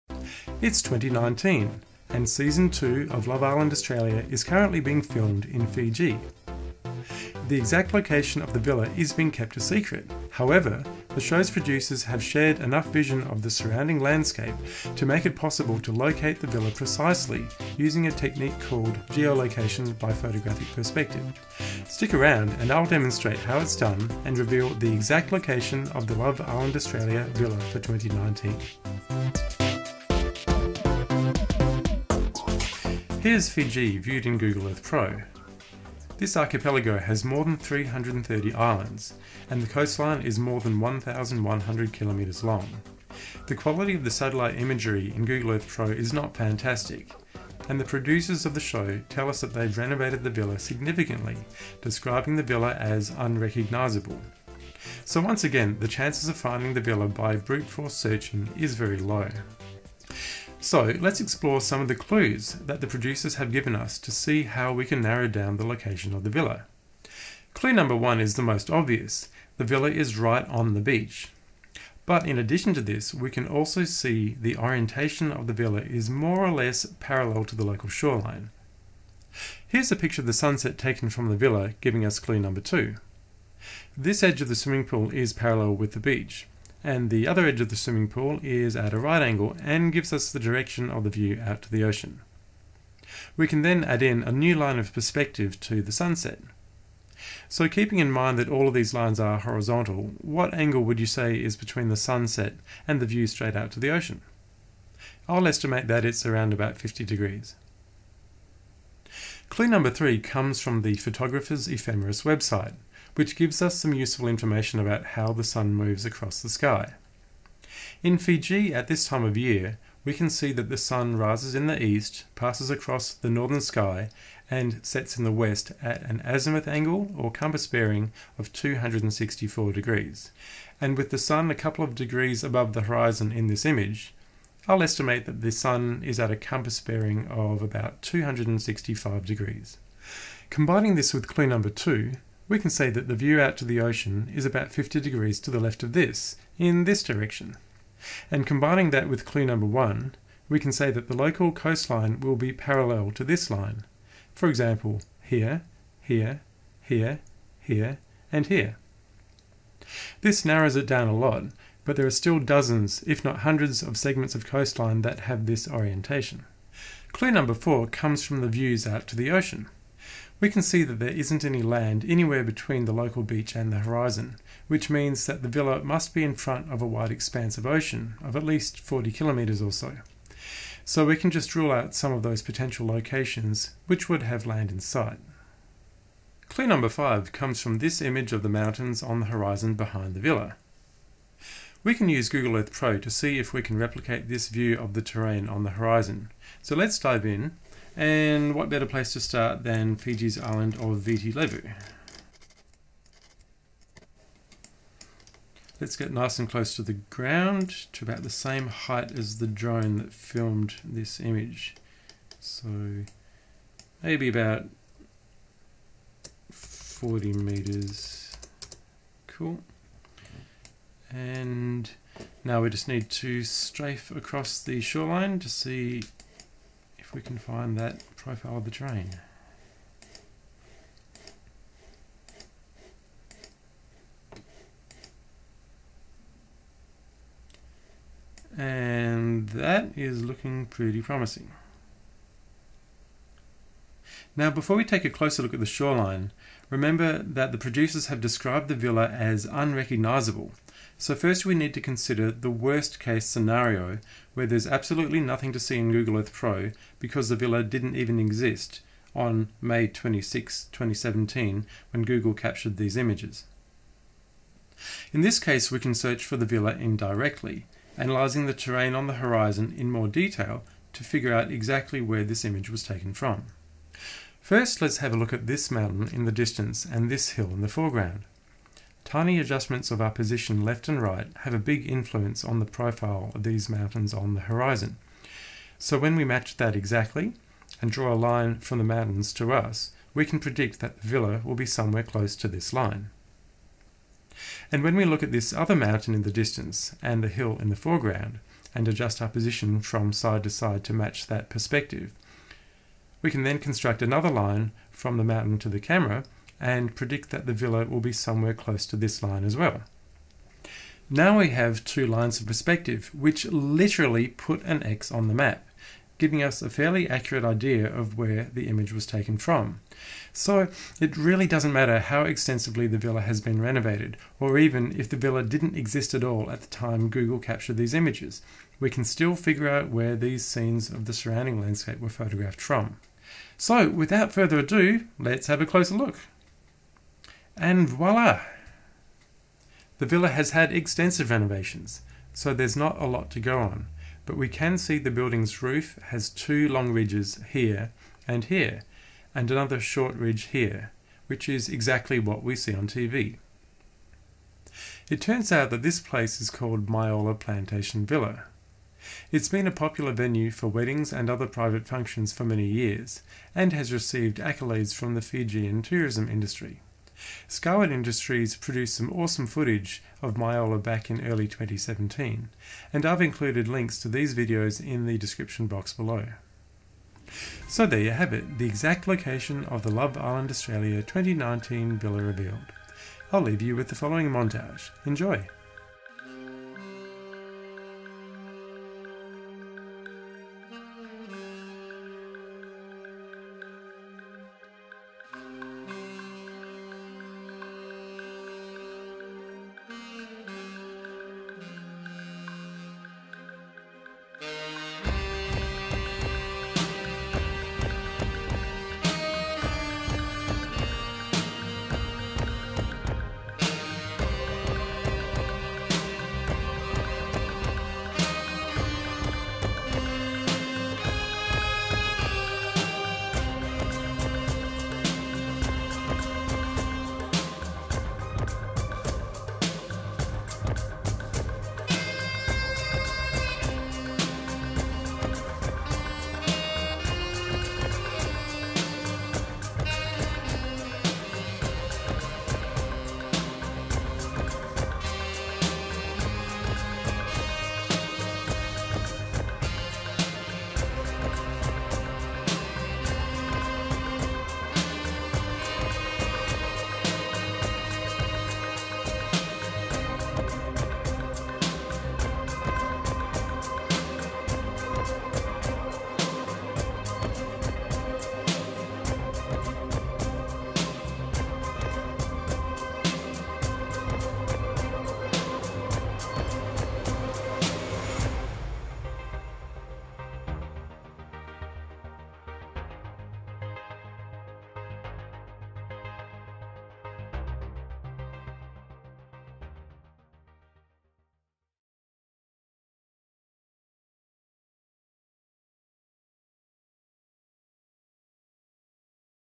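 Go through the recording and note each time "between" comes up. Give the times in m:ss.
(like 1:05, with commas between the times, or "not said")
1:41, 2:52.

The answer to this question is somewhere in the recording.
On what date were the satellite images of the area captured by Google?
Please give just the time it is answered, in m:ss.
4:19.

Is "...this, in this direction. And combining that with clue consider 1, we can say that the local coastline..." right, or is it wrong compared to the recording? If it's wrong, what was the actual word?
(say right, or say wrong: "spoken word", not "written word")
wrong: "number", not "consider".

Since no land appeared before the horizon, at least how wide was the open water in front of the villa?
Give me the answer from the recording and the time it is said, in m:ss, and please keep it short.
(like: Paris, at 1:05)
40 kilometres, at 2:58.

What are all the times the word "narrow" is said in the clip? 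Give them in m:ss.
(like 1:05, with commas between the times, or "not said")
1:05, 2:40.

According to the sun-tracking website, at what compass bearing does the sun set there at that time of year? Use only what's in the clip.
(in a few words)
264 degrees.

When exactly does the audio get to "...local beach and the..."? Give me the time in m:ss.
2:52.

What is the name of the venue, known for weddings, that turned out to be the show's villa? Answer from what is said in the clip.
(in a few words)
Myola Plantation Villa.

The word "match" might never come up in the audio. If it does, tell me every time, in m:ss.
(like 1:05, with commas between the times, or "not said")
4:46, 5:00.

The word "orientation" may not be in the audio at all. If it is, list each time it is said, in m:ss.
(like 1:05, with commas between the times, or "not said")
1:14, 2:45.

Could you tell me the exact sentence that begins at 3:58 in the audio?
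And that is looking pretty promising.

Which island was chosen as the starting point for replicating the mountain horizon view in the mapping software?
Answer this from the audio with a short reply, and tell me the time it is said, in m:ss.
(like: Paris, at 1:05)
Viti Levu, at 3:20.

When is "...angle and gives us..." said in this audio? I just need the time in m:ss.
1:29.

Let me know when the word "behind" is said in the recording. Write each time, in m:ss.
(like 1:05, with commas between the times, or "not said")
3:09.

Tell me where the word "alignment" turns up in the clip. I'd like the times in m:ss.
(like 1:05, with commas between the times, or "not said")
not said.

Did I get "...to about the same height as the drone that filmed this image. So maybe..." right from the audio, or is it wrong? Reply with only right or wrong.
right.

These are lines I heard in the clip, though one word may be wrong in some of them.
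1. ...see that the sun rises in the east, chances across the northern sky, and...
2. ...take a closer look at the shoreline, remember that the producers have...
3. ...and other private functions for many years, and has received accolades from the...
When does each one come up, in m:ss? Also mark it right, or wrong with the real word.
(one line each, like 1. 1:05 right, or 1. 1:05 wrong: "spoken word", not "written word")
1. 2:00 wrong: "passes", not "chances"
2. 4:04 right
3. 6:01 right.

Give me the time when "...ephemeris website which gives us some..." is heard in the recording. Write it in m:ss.
1:51.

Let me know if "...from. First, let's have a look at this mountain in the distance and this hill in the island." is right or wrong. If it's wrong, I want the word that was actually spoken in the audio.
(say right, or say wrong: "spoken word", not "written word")
wrong: "foreground", not "island".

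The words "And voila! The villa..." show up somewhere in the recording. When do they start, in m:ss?
5:37.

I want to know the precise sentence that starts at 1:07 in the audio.
Clue number one is the most obvious.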